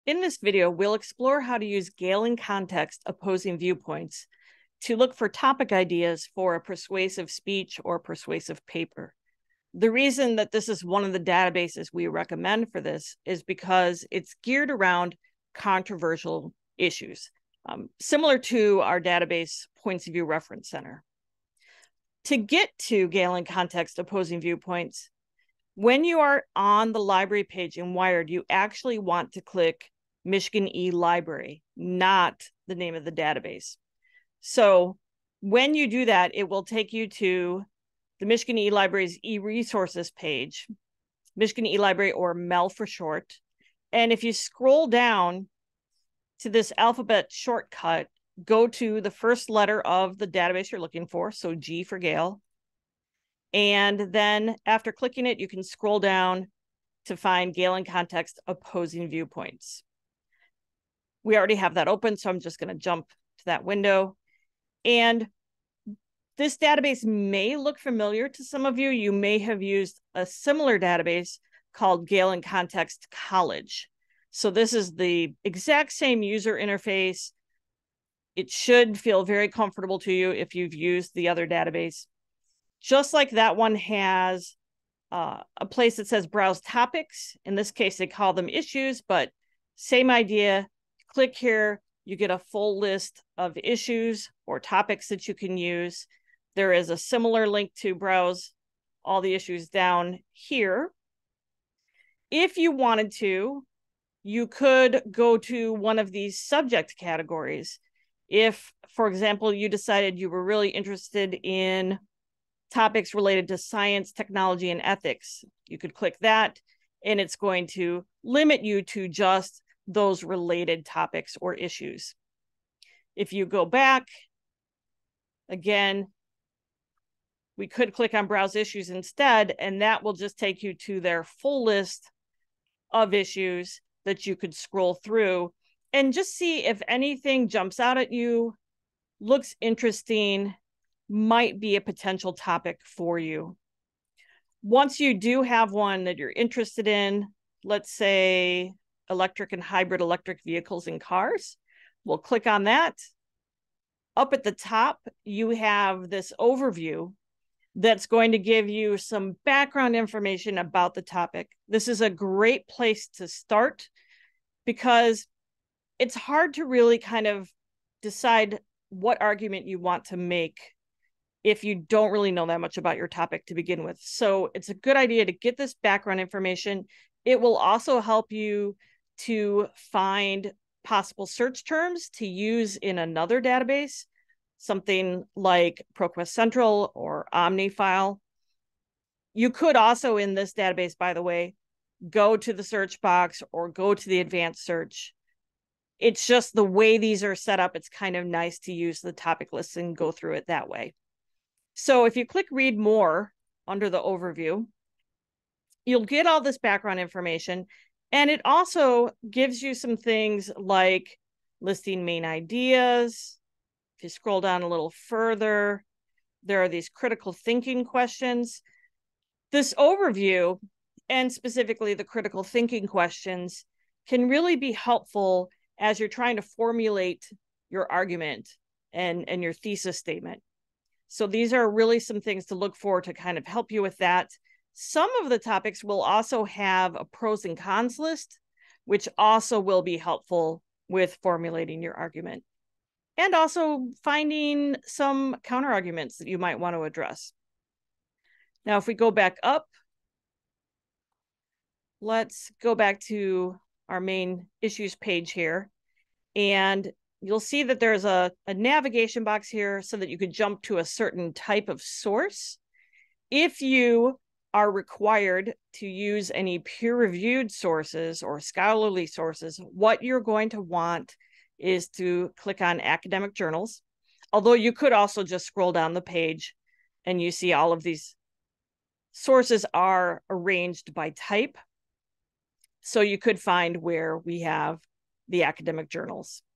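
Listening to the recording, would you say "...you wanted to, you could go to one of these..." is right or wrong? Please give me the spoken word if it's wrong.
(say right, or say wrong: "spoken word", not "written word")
right.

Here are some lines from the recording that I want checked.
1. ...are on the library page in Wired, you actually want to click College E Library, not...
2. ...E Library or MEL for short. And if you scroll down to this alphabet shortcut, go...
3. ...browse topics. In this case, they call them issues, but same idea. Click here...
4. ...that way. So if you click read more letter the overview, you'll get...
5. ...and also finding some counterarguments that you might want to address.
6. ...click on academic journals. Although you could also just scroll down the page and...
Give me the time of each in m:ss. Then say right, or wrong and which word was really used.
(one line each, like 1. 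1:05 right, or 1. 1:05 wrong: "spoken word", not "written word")
1. 0:26 wrong: "Michigan", not "College"
2. 0:41 right
3. 1:26 right
4. 3:20 wrong: "under", not "letter"
5. 4:03 right
6. 4:32 right.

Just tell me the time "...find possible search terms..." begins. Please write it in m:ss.
2:59.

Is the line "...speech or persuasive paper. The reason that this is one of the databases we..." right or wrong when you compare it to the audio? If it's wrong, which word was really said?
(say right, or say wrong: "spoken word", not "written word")
right.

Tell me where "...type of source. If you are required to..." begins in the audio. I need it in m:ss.
4:21.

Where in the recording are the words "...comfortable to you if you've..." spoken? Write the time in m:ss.
1:19.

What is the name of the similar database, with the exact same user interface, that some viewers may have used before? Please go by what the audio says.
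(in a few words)
Gale in Context College.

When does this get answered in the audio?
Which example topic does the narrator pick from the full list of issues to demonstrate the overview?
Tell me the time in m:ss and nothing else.
2:29.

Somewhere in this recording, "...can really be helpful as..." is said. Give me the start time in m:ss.
3:44.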